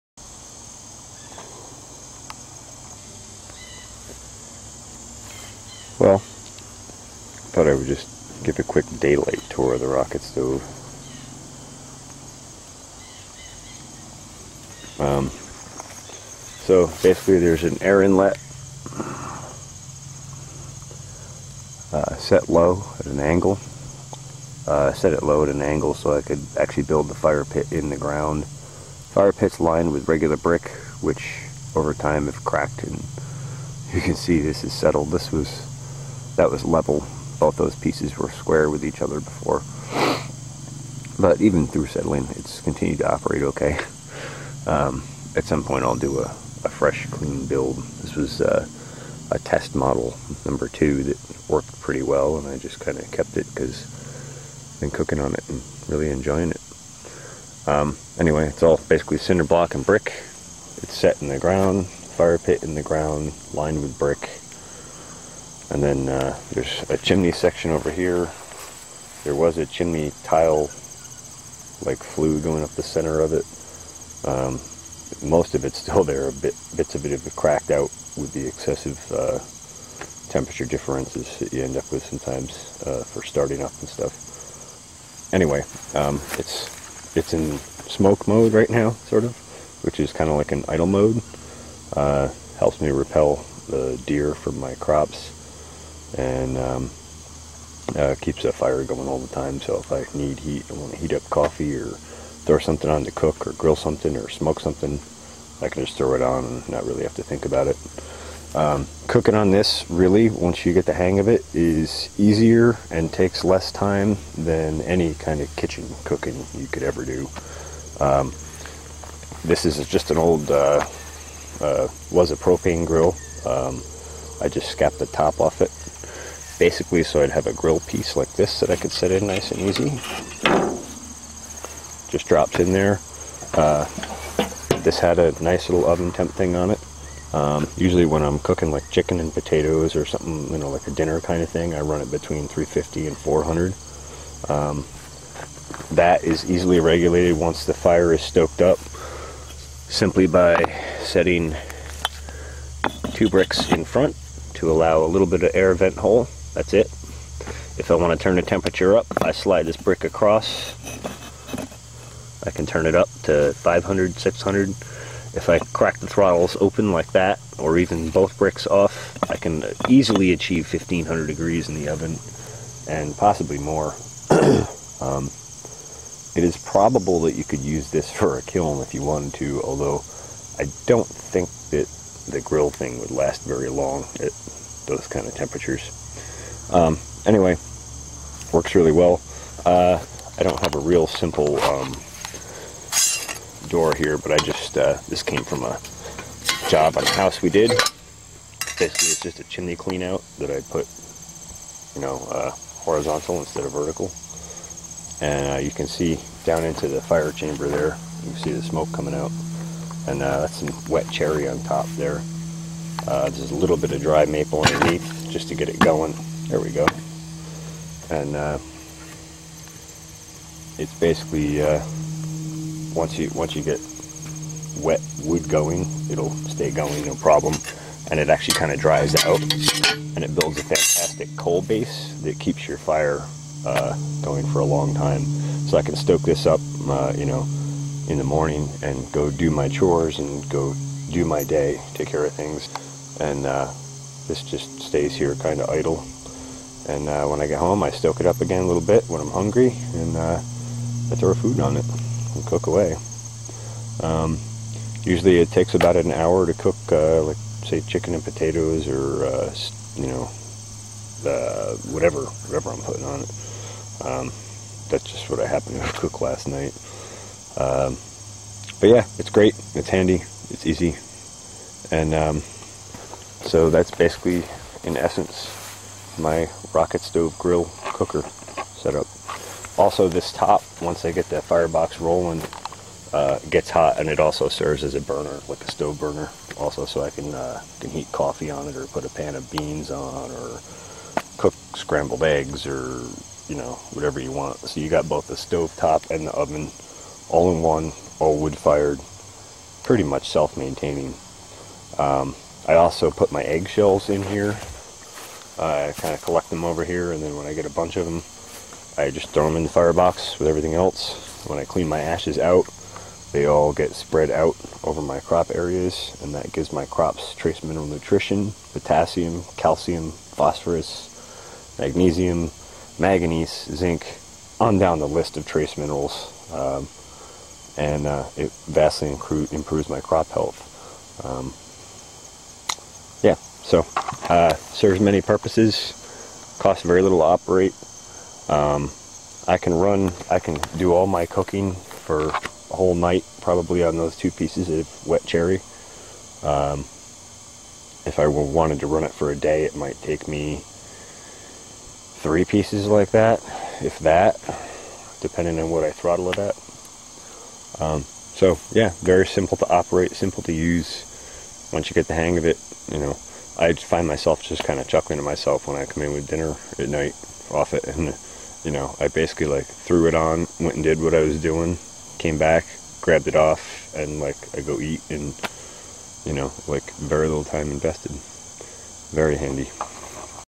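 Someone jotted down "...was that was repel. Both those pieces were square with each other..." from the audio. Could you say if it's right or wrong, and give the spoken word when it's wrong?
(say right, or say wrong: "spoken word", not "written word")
wrong: "level", not "repel".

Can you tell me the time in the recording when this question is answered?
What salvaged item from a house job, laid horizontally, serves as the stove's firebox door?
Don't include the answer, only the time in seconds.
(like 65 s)
199 s.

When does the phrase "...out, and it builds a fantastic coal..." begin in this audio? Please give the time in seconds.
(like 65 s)
229 s.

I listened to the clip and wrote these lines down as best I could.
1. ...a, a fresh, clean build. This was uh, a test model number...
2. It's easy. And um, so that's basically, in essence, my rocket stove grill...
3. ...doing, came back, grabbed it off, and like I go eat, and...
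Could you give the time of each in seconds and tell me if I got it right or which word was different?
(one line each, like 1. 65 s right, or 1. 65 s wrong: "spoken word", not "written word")
1. 46 s right
2. 270 s right
3. 371 s right.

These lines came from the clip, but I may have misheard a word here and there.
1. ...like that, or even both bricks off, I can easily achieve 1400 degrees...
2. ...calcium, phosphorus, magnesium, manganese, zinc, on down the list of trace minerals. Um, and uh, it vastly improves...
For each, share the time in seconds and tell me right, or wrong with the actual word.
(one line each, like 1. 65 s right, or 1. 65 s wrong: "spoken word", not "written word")
1. 166 s wrong: "1500", not "1400"
2. 319 s right.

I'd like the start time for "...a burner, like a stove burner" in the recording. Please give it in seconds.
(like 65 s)
284 s.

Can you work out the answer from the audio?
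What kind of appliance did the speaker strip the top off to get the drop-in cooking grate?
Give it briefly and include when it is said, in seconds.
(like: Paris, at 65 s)
propane grill, at 122 s.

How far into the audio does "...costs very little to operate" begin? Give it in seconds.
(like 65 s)
336 s.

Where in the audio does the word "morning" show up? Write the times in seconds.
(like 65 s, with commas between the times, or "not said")
238 s.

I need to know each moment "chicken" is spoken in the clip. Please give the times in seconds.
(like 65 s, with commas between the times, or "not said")
138 s, 257 s.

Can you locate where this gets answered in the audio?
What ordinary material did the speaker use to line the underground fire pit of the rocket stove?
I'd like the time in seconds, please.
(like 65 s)
30 s.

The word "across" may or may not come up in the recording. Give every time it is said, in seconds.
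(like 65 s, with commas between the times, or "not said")
160 s.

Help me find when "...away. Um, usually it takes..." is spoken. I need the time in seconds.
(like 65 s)
252 s.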